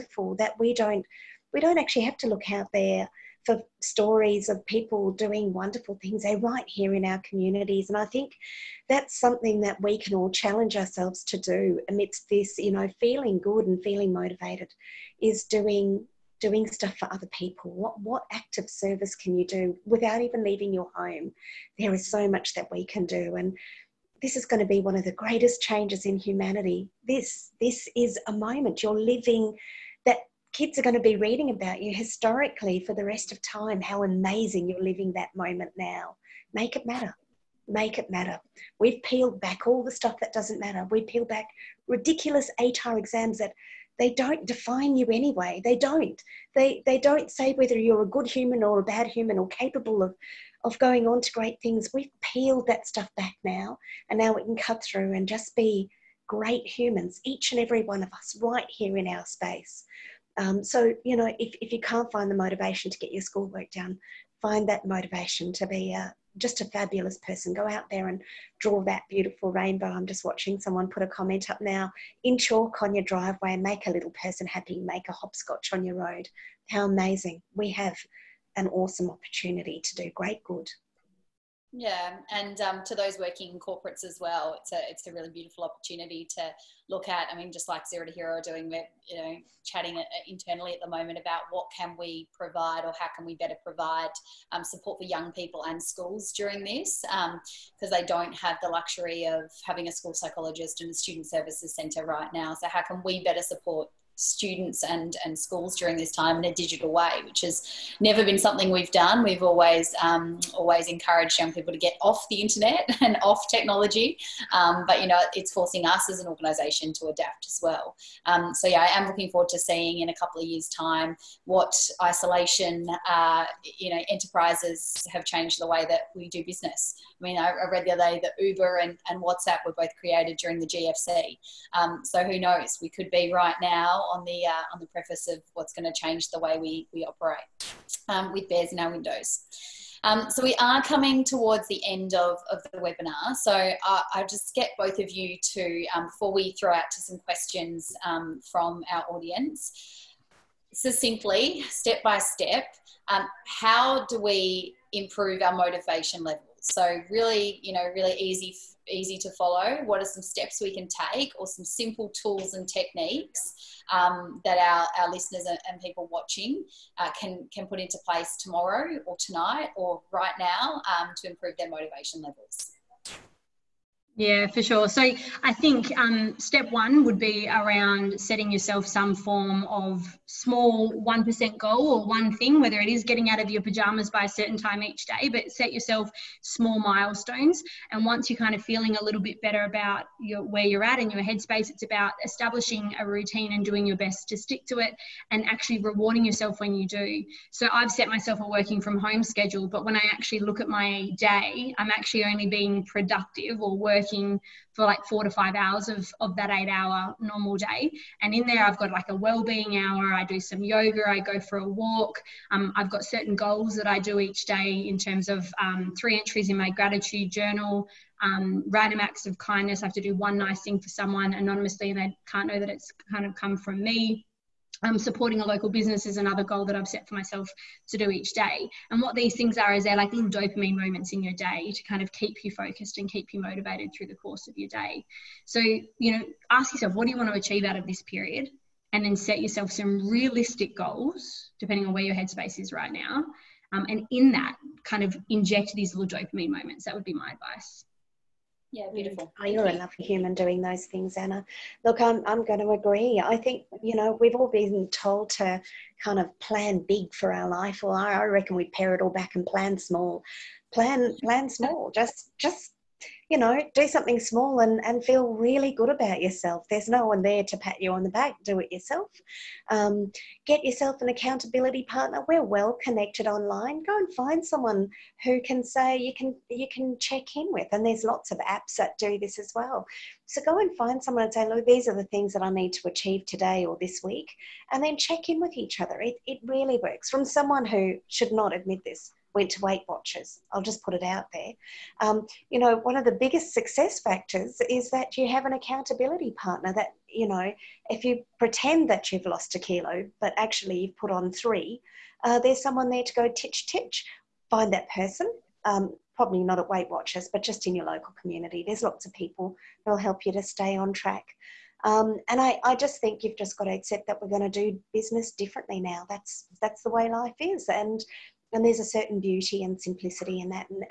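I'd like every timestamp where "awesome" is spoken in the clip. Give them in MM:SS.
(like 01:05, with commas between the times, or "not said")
01:18.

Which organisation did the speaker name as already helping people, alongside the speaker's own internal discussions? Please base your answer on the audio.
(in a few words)
Zero to Hero.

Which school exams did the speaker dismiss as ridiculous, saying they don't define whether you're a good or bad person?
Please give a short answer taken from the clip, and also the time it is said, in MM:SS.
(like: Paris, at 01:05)
ATAR, at 00:42.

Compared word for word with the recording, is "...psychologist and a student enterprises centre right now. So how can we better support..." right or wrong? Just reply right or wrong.
wrong.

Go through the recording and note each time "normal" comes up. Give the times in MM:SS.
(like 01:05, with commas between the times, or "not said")
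03:27.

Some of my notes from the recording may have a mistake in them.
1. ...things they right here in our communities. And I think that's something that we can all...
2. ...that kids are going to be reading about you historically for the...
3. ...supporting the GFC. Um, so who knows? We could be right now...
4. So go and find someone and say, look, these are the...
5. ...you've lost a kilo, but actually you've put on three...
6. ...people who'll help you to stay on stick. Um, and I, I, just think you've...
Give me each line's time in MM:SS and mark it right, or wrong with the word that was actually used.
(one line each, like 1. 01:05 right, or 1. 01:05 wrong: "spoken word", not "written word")
1. 00:06 right
2. 00:30 right
3. 02:10 wrong: "during", not "supporting"
4. 04:40 right
5. 04:59 right
6. 05:09 wrong: "track", not "stick".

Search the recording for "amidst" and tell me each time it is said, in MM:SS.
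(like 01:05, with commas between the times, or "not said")
00:11.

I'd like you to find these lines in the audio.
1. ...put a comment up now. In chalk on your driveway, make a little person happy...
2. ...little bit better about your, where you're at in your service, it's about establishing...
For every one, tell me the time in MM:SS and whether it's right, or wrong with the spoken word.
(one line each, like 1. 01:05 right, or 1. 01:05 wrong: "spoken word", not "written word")
1. 01:10 right
2. 03:09 wrong: "headspace", not "service".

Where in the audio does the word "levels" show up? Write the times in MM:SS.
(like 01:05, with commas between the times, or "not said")
02:36, 02:52.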